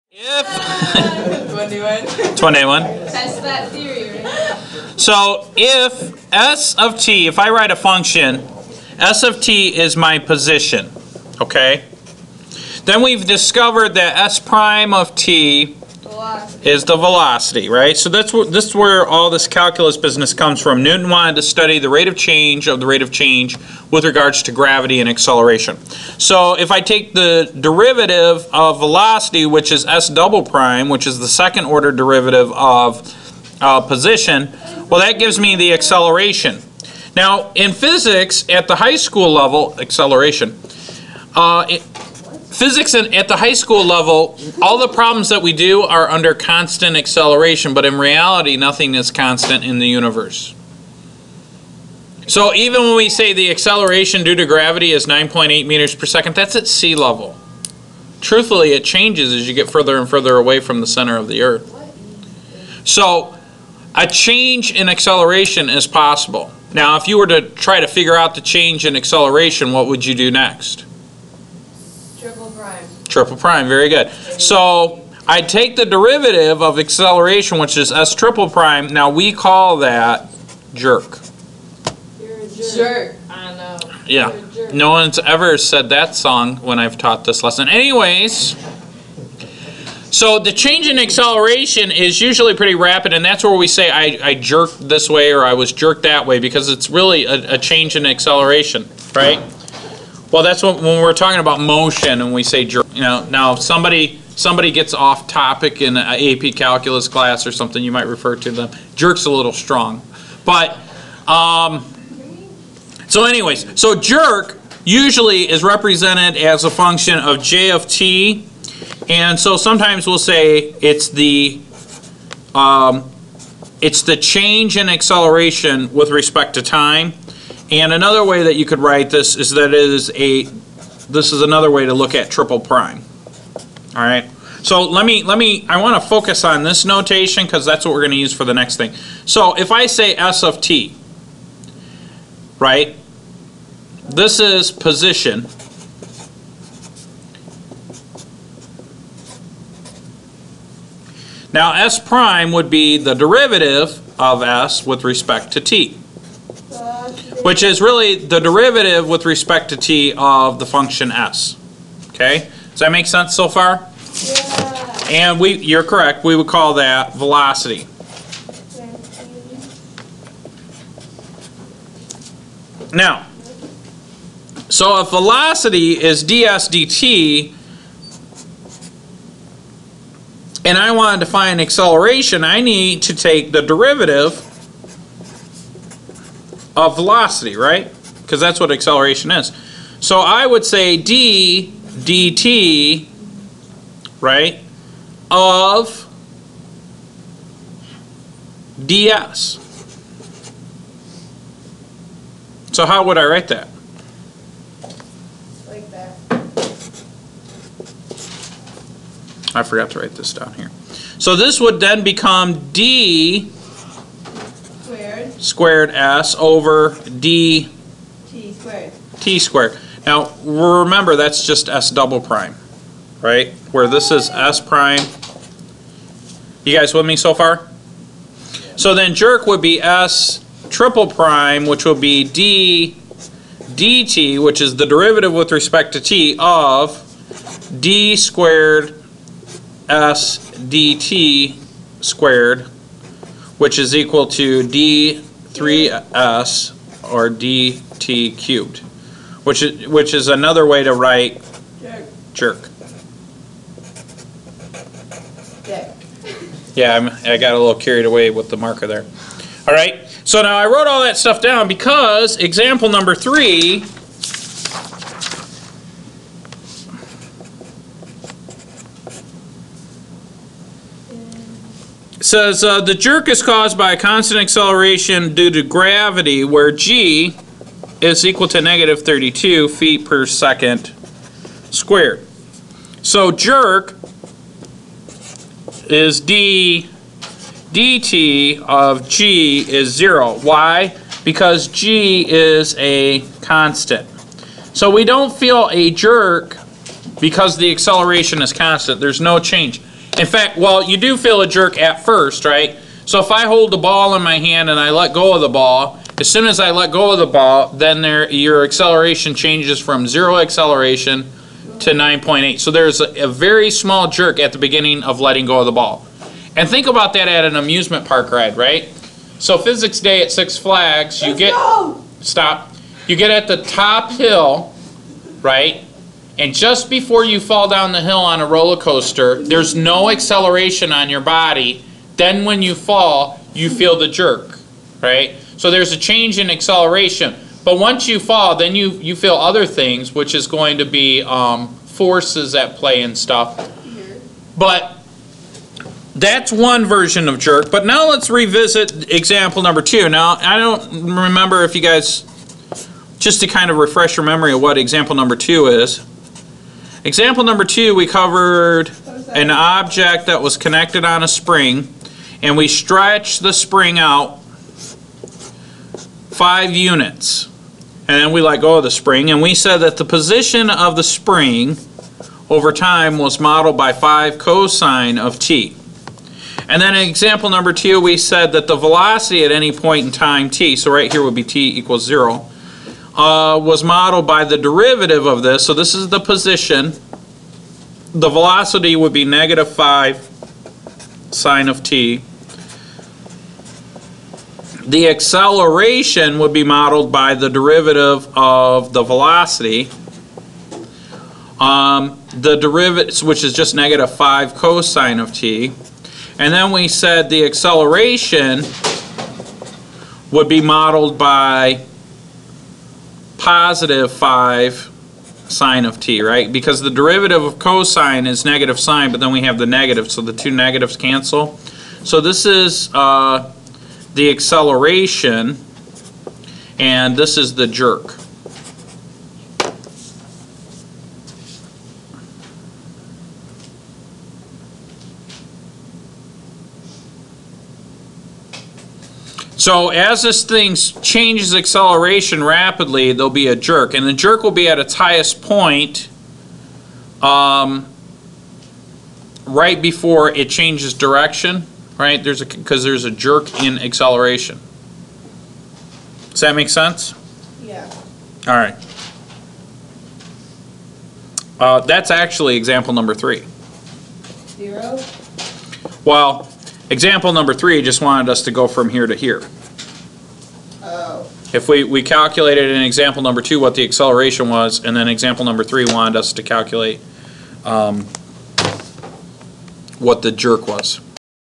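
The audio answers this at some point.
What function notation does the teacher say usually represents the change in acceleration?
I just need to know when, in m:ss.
1:57.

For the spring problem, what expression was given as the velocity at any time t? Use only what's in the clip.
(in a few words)
negative 5 sine of t.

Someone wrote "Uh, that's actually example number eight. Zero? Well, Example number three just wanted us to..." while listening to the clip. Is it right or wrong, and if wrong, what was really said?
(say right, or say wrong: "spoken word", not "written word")
wrong: "three", not "eight".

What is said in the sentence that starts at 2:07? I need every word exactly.
And another way that you could write this is that it is a, this is another way to look at triple prime.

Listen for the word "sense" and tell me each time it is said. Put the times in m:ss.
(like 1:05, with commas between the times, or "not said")
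2:43, 7:36.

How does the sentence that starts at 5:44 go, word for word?
But that's one version of jerk.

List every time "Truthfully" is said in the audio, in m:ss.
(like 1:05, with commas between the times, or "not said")
0:58.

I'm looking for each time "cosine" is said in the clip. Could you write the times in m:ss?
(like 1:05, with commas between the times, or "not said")
6:14, 6:44, 6:57.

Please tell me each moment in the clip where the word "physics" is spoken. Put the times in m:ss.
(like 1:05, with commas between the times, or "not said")
0:37, 0:42, 5:19.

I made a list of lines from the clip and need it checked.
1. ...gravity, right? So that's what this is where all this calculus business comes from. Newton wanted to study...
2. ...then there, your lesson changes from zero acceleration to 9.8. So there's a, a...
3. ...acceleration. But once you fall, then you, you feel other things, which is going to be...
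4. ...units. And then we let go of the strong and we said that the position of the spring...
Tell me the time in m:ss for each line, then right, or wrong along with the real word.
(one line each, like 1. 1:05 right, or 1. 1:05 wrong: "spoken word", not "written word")
1. 0:16 wrong: "velocity", not "gravity"
2. 5:07 wrong: "acceleration", not "lesson"
3. 5:36 right
4. 6:06 wrong: "spring", not "strong".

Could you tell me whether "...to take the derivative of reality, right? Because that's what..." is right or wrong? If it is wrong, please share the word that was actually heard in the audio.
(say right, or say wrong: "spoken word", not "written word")
wrong: "velocity", not "reality".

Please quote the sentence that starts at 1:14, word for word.
So I take the derivative of acceleration, which is s triple prime.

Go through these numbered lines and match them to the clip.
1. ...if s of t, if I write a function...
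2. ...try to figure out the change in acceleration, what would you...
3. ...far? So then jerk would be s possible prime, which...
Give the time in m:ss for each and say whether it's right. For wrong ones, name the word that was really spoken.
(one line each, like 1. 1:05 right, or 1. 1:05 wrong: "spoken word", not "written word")
1. 0:05 right
2. 1:07 right
3. 3:47 wrong: "triple", not "possible".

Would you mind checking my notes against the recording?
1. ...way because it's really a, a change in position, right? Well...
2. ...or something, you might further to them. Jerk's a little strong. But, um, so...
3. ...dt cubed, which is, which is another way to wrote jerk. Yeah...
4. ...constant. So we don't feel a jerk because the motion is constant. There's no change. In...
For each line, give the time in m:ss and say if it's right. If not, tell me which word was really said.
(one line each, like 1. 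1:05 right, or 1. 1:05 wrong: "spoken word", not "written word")
1. 1:36 wrong: "acceleration", not "position"
2. 1:47 wrong: "refer", not "further"
3. 4:07 wrong: "write", not "wrote"
4. 4:53 wrong: "acceleration", not "motion".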